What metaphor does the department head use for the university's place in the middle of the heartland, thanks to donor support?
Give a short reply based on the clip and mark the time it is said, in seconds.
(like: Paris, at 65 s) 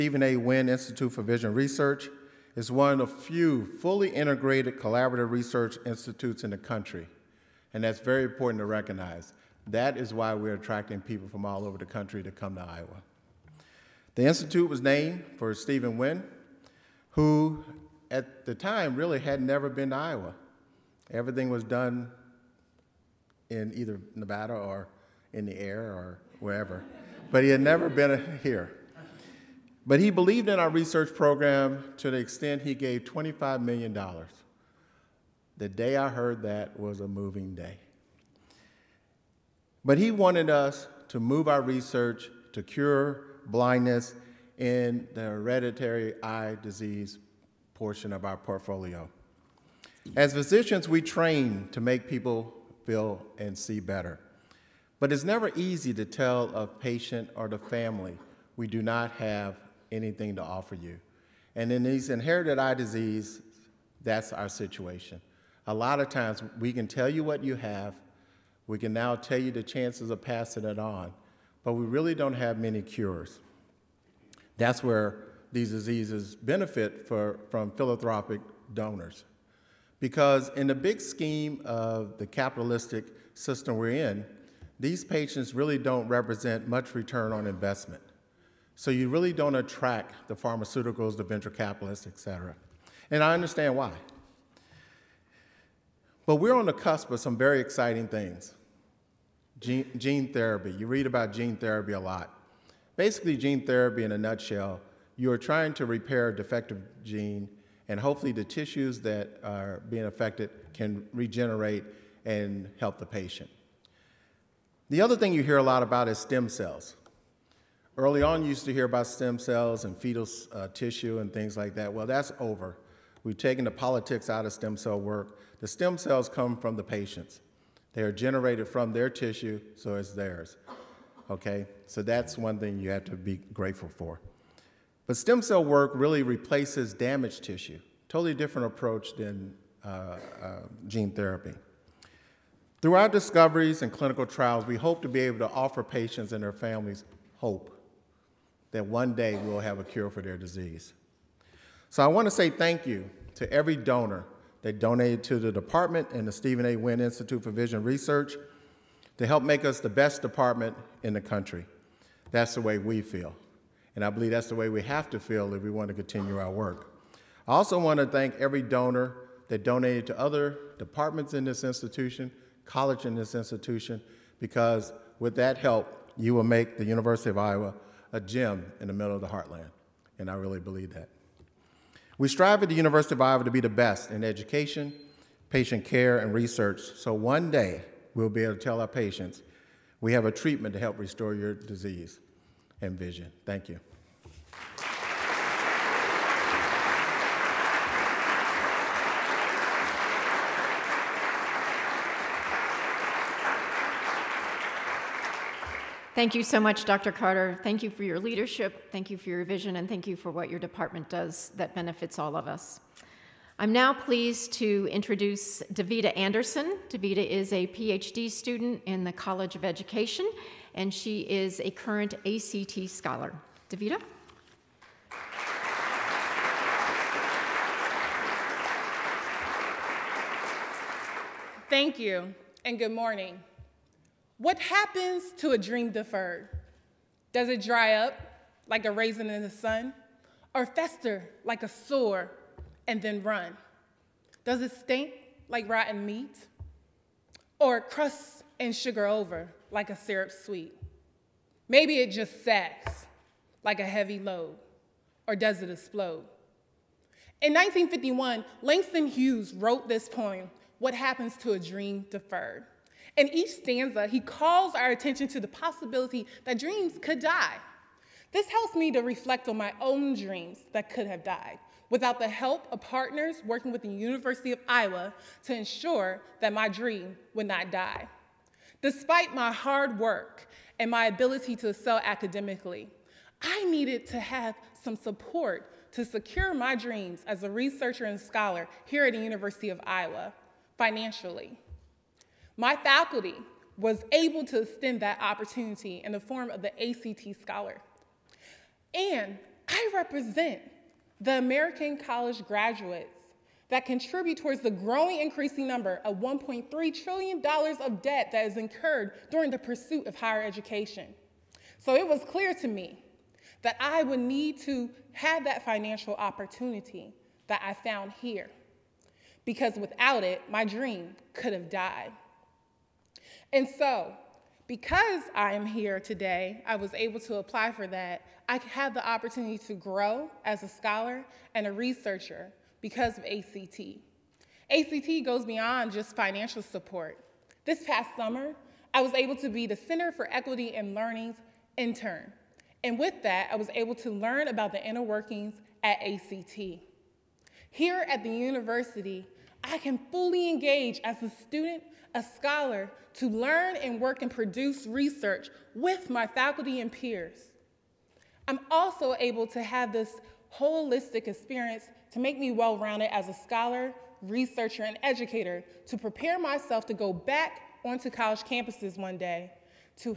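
A gem, at 178 s.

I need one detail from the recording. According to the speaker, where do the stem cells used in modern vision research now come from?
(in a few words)
The patients.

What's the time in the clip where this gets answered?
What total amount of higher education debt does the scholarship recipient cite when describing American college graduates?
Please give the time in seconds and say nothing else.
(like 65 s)
306 s.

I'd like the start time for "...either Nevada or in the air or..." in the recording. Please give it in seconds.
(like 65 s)
23 s.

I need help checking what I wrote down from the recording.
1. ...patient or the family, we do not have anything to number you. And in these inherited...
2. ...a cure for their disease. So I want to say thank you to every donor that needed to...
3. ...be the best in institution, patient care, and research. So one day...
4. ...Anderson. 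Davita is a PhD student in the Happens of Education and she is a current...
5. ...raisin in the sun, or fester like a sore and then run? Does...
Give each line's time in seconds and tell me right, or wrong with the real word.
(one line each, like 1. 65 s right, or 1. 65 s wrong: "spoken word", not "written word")
1. 56 s wrong: "offer", not "number"
2. 149 s wrong: "donated", not "needed"
3. 183 s wrong: "education", not "institution"
4. 216 s wrong: "College", not "Happens"
5. 238 s right.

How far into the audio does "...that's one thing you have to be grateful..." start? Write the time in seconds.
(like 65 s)
132 s.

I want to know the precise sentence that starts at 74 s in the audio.
That's where these diseases benefit for, from philanthropic donors.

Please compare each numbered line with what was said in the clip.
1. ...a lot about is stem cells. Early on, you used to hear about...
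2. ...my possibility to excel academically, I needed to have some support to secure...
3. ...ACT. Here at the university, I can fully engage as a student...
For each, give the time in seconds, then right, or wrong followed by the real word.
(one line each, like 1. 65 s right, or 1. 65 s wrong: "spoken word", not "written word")
1. 115 s right
2. 280 s wrong: "ability", not "possibility"
3. 346 s right.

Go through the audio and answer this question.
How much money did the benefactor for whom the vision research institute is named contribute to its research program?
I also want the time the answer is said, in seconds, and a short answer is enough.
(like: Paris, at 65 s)
$25 million, at 33 s.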